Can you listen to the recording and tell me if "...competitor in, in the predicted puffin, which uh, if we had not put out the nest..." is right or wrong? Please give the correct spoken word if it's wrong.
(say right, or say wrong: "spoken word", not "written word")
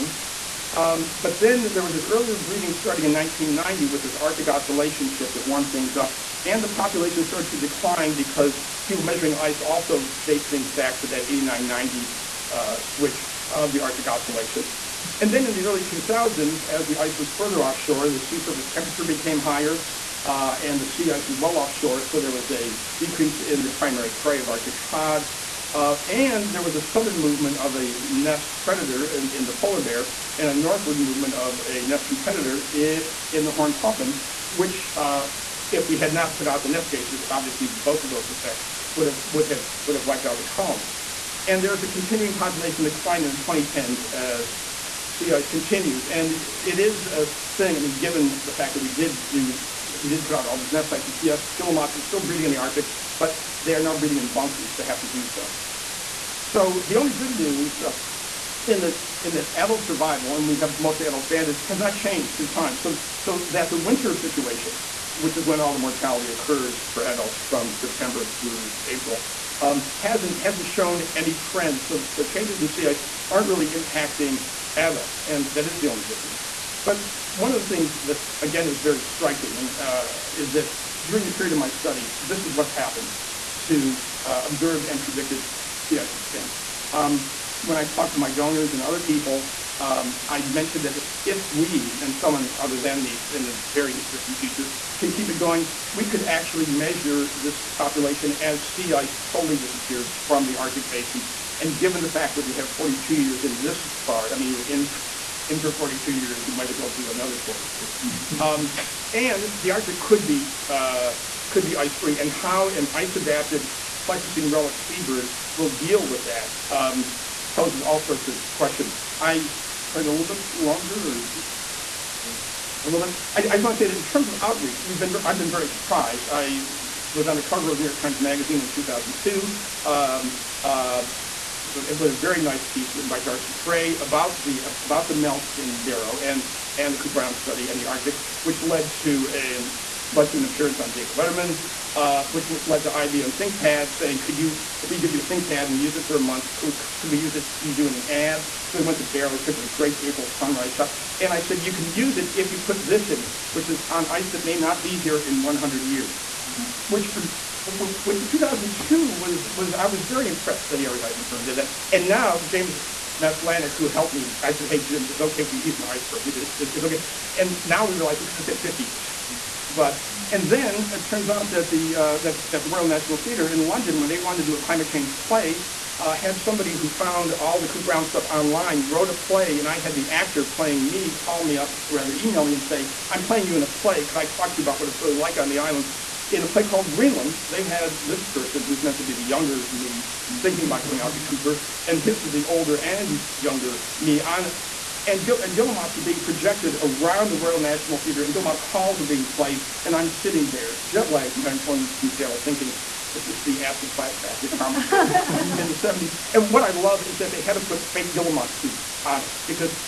wrong: "horned", not "predicted".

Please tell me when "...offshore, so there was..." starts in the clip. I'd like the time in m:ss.
0:21.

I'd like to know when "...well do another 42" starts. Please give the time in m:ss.
1:46.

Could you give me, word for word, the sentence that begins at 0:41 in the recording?
And there's a continuing population decline in the 2010s as sea ice continues.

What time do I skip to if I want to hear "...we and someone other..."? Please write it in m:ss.
1:31.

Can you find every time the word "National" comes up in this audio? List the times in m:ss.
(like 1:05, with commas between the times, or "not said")
2:52, 3:17.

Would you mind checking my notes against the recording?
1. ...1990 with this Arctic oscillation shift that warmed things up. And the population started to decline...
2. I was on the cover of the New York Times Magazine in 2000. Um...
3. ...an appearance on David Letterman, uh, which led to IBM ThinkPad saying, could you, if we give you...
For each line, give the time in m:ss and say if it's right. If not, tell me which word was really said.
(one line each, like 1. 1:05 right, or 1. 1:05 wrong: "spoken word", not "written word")
1. 0:03 right
2. 2:06 wrong: "2002", not "2000"
3. 2:20 right.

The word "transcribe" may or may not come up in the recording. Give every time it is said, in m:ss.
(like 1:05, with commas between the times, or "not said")
not said.